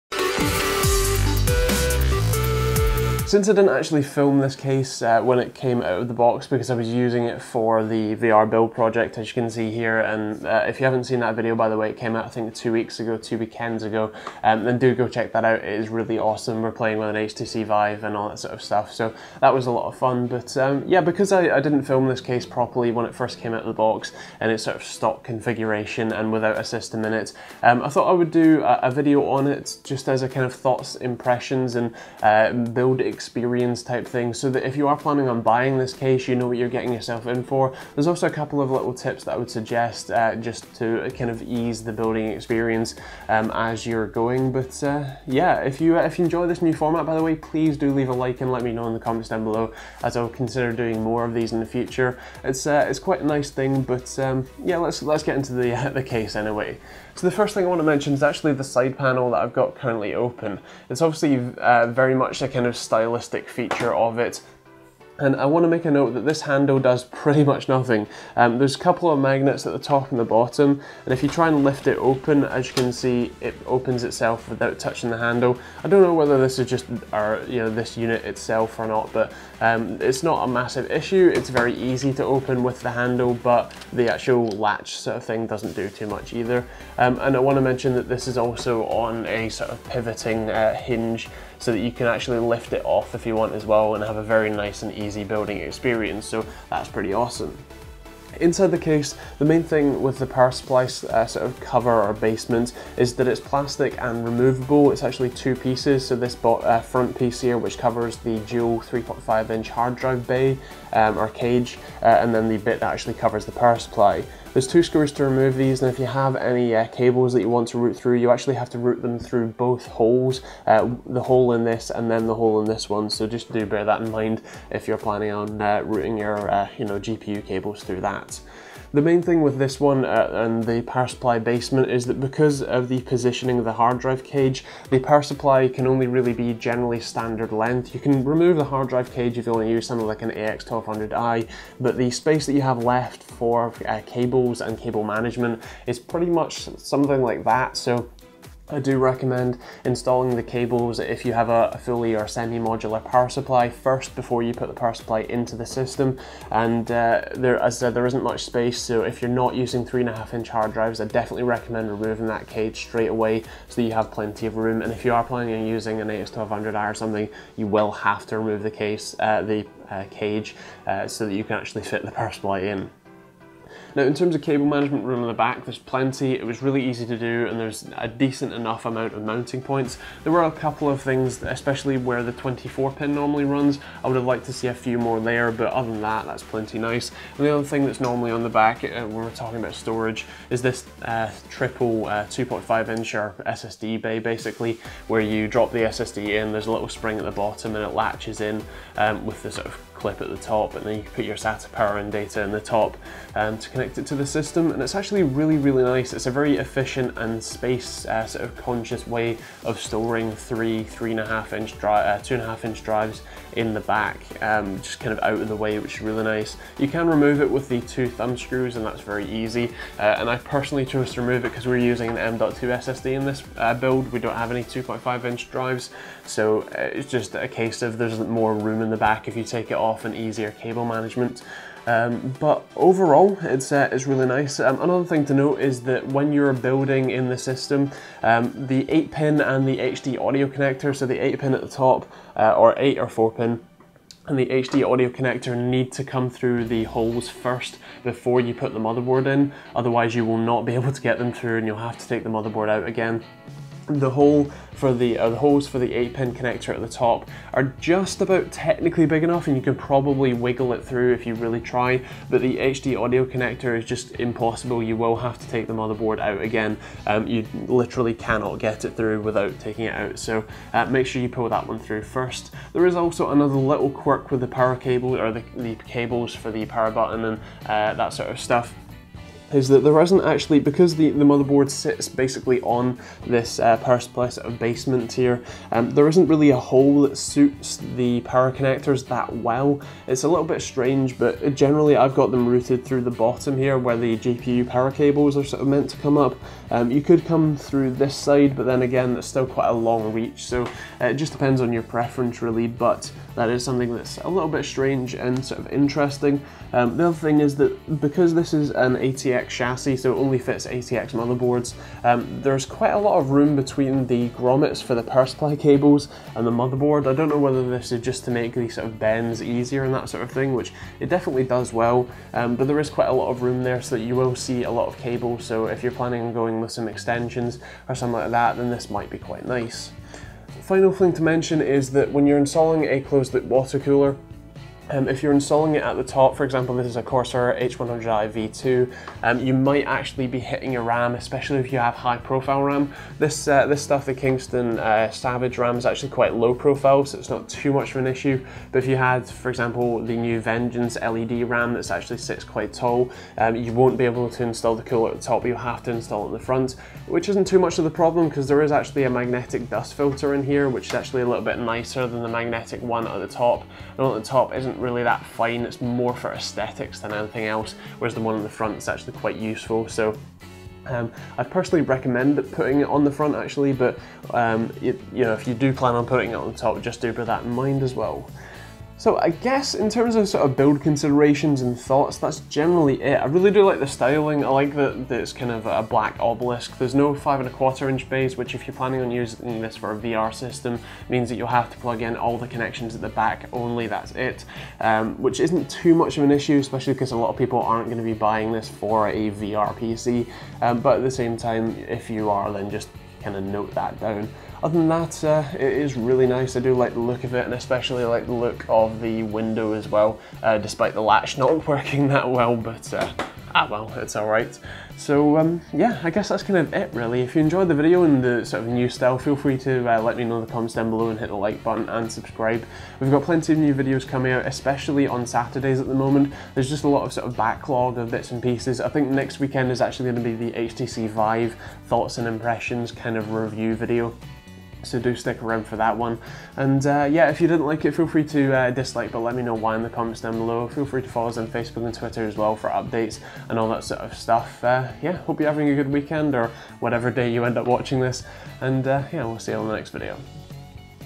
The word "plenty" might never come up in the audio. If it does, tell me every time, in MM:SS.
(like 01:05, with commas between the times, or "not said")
02:44, 02:55, 03:06, 07:03.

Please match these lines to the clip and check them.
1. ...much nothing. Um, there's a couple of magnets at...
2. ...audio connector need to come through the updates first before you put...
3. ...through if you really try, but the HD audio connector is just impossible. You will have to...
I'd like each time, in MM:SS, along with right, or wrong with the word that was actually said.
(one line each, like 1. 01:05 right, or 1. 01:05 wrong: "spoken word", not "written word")
1. 01:07 right
2. 04:04 wrong: "holes", not "updates"
3. 04:20 right.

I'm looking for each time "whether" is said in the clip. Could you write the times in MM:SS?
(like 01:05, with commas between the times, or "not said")
01:16, 05:17.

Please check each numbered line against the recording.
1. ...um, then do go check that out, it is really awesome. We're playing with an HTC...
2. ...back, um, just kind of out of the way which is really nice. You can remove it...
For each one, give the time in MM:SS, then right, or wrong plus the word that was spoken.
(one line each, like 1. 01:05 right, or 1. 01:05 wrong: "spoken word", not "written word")
1. 00:14 right
2. 03:33 right.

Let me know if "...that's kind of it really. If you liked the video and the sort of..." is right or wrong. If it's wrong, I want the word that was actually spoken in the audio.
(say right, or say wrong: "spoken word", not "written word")
wrong: "enjoyed", not "liked".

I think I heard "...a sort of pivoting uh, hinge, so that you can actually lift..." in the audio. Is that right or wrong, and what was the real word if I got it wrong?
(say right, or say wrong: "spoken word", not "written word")
right.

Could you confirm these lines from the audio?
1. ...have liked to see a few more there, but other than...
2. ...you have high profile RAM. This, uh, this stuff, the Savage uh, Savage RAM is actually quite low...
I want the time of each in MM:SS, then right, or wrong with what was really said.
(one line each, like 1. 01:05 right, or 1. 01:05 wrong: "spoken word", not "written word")
1. 03:04 right
2. 05:41 wrong: "Kingston", not "Savage".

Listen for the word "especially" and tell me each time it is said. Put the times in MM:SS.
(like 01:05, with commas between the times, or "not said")
03:01, 05:41, 06:36, 06:47, 07:04.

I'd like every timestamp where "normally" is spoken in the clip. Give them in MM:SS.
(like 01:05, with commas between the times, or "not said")
03:03, 03:07.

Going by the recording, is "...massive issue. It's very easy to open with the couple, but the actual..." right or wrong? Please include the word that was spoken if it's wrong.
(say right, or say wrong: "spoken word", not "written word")
wrong: "handle", not "couple".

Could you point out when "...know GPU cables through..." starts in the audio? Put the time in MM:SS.
02:06.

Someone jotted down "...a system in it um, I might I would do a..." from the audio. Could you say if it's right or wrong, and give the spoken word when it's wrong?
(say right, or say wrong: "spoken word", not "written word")
wrong: "thought", not "might".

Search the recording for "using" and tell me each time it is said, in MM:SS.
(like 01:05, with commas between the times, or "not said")
00:06, 02:39, 02:45, 03:41, 06:29.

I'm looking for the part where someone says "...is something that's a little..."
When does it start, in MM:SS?
05:03.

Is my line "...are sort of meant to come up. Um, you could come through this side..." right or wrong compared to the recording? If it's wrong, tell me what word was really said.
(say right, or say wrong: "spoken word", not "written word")
right.